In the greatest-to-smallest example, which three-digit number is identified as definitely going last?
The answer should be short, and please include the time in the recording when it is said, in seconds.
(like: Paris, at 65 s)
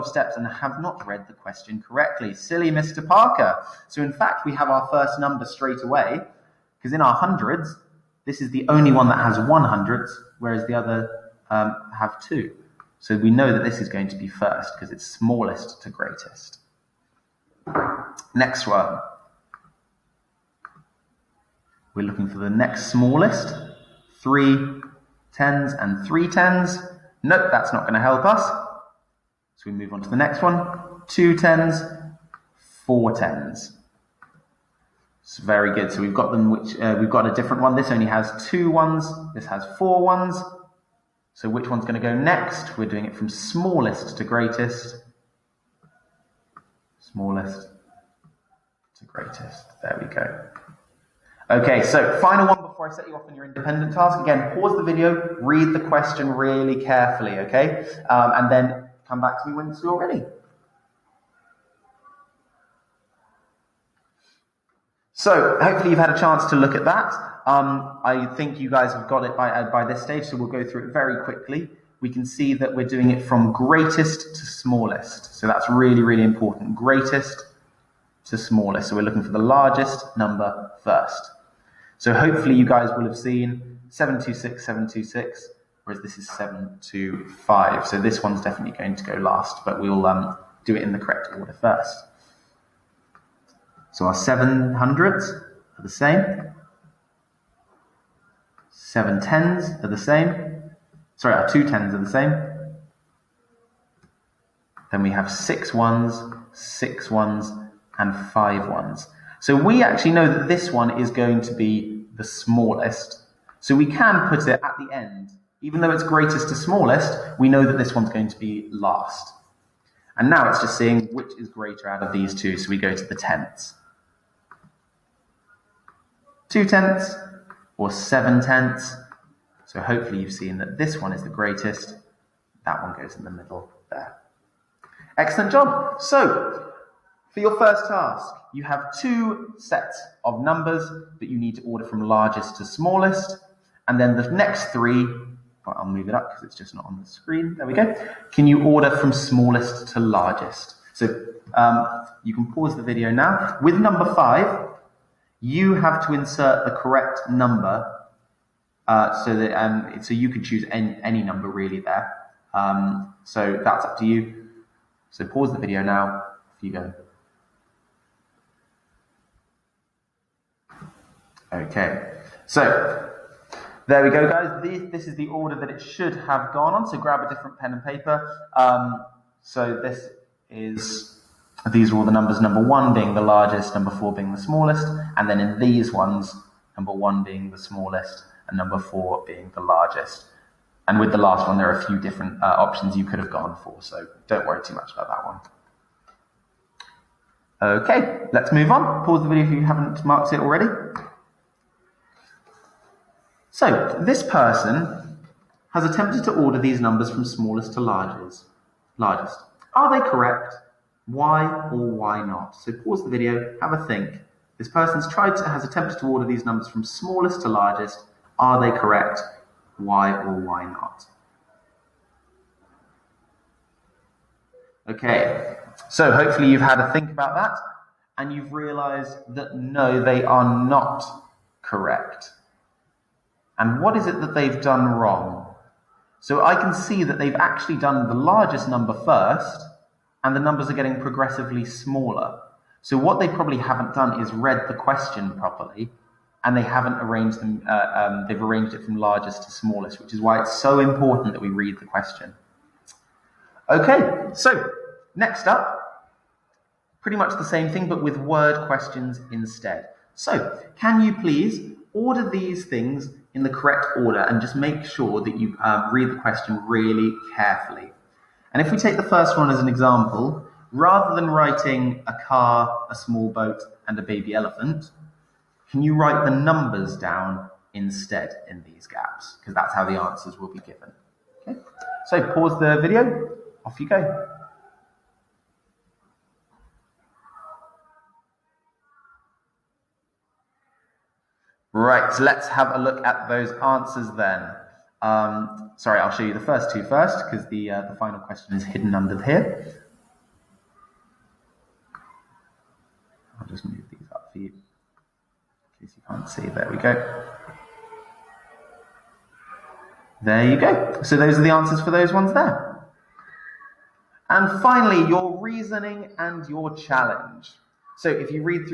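725, at 86 s.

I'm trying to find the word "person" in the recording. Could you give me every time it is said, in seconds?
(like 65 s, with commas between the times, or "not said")
204 s, 214 s.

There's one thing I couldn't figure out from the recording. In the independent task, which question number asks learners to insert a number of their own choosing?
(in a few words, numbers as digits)
5.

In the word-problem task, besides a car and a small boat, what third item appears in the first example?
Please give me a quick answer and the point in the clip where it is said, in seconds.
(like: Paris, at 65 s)
a baby elephant, at 273 s.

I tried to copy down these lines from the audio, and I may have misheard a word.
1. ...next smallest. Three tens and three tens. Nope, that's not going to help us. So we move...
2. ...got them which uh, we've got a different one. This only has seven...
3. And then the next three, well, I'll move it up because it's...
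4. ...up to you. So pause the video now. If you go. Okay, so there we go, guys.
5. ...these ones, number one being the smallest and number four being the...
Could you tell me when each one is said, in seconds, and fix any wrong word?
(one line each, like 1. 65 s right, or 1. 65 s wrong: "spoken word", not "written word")
1. 22 s right
2. 36 s wrong: "two", not "seven"
3. 143 s right
4. 163 s right
5. 185 s right.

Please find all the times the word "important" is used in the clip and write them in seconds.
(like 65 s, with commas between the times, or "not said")
76 s, 250 s.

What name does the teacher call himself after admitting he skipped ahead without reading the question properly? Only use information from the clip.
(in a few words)
Mr. Parker.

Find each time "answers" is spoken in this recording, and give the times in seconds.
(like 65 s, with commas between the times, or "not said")
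279 s, 293 s, 311 s.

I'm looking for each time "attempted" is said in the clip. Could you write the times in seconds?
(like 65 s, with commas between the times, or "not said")
205 s, 215 s.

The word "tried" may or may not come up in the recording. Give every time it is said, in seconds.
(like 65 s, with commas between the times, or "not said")
215 s.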